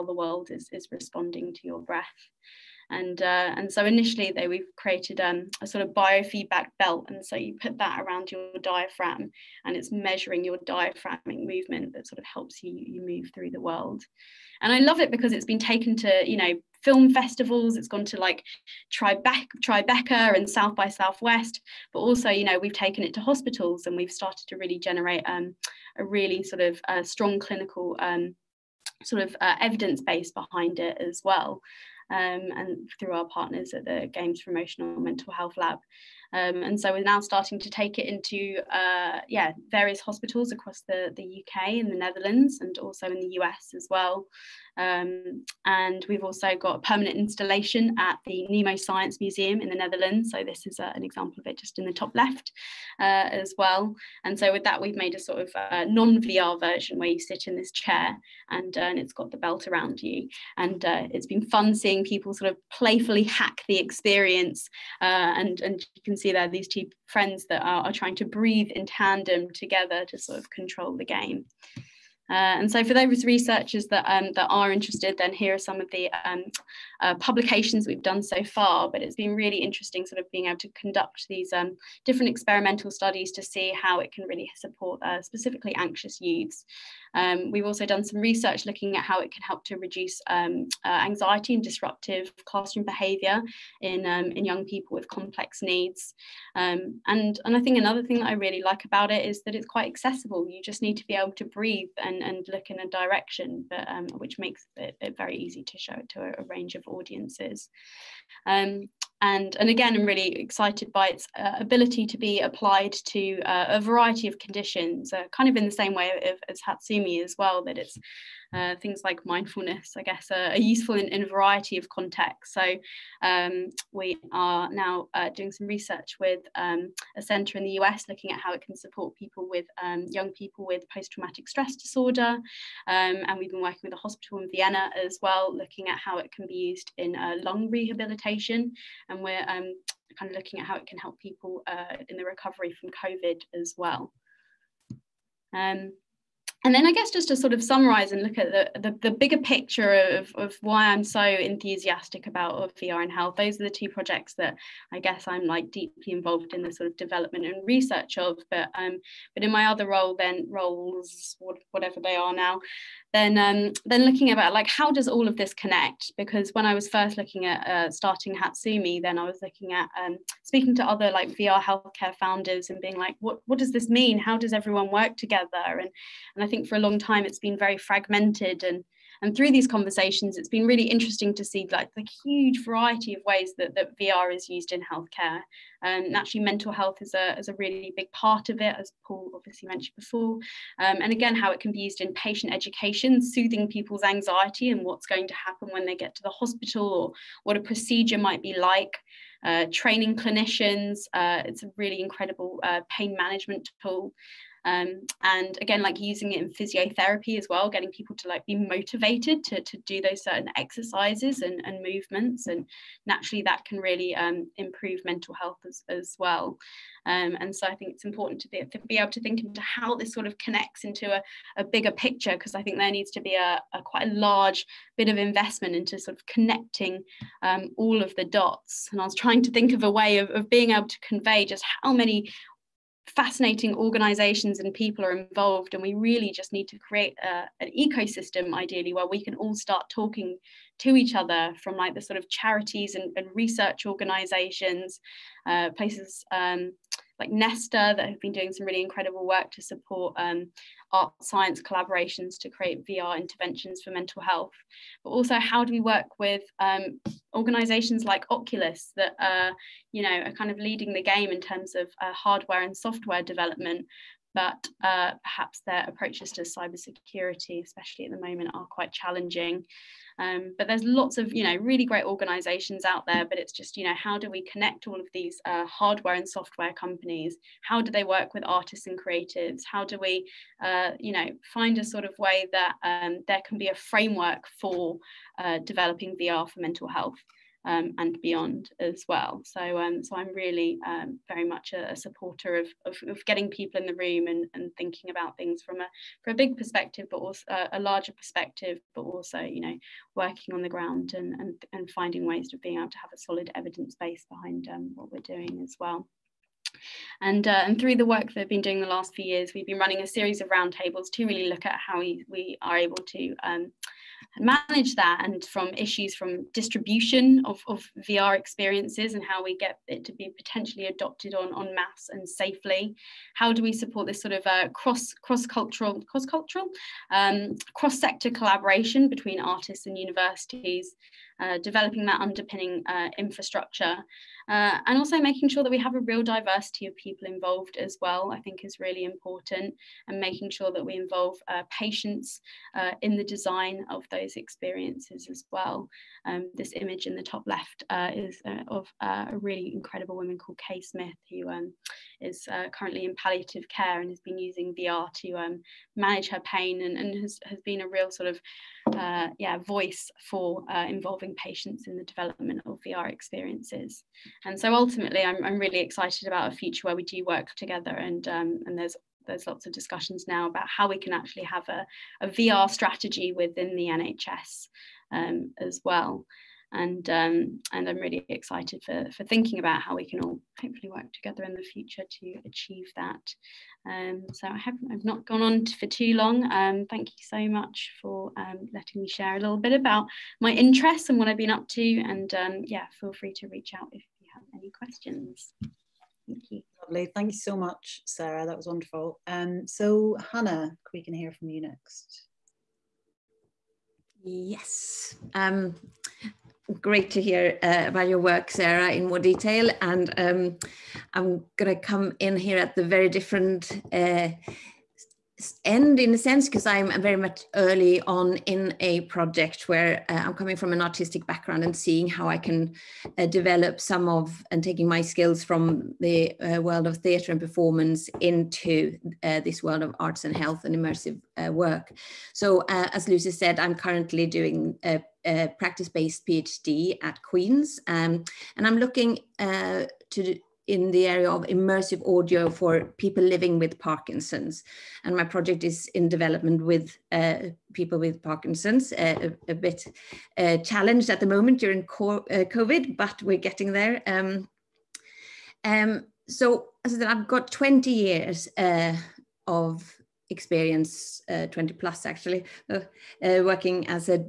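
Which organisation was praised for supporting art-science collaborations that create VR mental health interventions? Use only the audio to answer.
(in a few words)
Nesta.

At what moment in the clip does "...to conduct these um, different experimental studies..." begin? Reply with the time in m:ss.
1:20.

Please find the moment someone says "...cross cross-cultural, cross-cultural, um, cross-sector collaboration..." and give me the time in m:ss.
5:24.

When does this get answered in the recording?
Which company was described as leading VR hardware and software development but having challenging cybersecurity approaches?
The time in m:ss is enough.
4:18.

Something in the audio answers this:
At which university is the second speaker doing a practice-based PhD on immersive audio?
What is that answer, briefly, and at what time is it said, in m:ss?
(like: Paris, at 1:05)
Queen's, at 7:17.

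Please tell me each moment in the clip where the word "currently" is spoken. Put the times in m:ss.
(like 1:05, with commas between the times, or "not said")
5:52, 7:13.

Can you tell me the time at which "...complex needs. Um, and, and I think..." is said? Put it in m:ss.
1:35.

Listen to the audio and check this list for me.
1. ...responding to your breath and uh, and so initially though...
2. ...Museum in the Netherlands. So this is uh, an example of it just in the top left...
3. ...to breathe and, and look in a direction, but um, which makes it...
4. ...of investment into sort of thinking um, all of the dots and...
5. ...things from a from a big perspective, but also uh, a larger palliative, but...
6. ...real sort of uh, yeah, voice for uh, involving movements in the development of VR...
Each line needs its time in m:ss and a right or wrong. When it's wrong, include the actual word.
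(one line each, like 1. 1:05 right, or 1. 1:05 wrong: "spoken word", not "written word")
1. 0:00 right
2. 0:49 right
3. 1:41 right
4. 3:45 wrong: "connecting", not "thinking"
5. 4:55 wrong: "perspective", not "palliative"
6. 5:57 wrong: "patients", not "movements".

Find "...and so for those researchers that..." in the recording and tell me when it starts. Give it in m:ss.
1:12.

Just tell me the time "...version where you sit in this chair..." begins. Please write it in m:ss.
0:56.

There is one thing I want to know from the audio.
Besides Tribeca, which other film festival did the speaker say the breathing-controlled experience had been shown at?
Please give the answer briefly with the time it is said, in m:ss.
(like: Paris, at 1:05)
South by Southwest, at 0:20.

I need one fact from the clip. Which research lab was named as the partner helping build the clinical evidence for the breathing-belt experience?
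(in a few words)
Games for Emotional Mental Health Lab.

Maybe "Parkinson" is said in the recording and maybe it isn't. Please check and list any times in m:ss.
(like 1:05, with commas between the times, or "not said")
7:23, 7:28.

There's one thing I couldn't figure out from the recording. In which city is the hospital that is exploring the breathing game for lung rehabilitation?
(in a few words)
Vienna.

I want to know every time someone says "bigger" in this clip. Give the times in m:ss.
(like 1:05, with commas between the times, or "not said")
2:29, 3:41.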